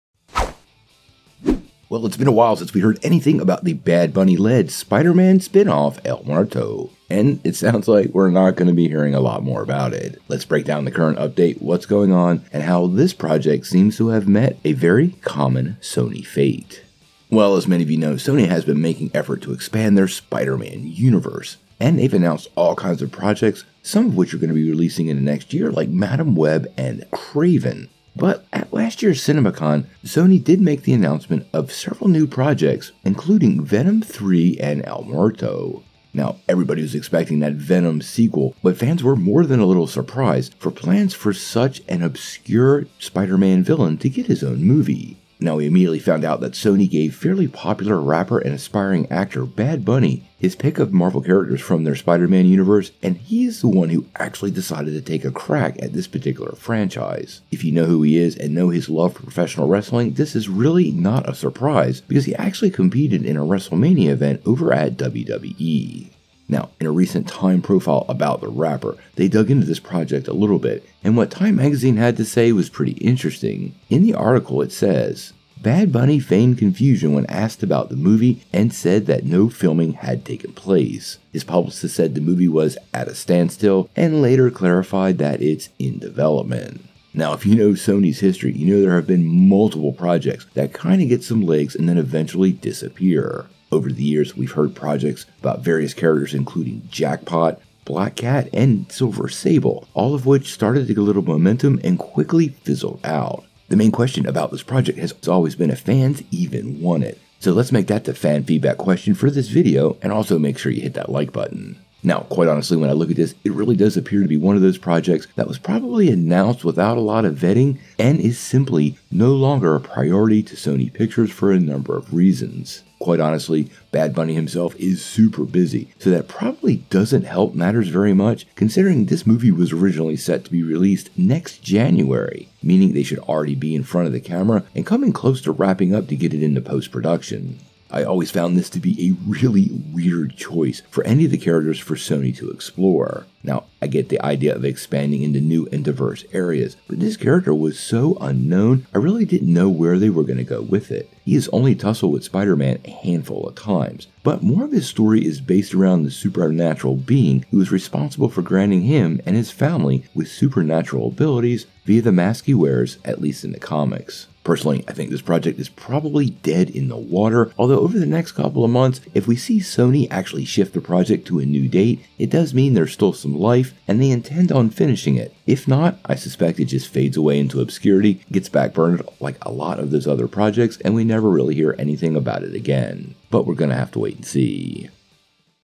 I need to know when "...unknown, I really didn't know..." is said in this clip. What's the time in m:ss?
2:28.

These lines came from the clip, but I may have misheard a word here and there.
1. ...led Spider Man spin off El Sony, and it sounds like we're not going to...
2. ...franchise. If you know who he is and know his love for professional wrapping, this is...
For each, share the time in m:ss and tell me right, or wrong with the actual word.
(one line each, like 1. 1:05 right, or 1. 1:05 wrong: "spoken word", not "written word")
1. 0:04 wrong: "Muerto", not "Sony"
2. 0:56 wrong: "wrestling", not "wrapping".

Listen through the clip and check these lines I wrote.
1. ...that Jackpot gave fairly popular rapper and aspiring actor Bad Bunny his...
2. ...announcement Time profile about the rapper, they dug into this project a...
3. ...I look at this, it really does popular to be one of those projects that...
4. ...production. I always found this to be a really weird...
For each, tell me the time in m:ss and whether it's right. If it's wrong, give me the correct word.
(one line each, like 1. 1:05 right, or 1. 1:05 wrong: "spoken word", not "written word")
1. 0:46 wrong: "Sony", not "Jackpot"
2. 1:06 wrong: "recent", not "announcement"
3. 1:52 wrong: "appear", not "popular"
4. 2:16 right.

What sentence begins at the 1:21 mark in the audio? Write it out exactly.
His publicist said the movie was at a standstill and later clarified that it's in development.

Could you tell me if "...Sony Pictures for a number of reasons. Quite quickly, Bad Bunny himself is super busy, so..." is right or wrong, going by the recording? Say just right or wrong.
wrong.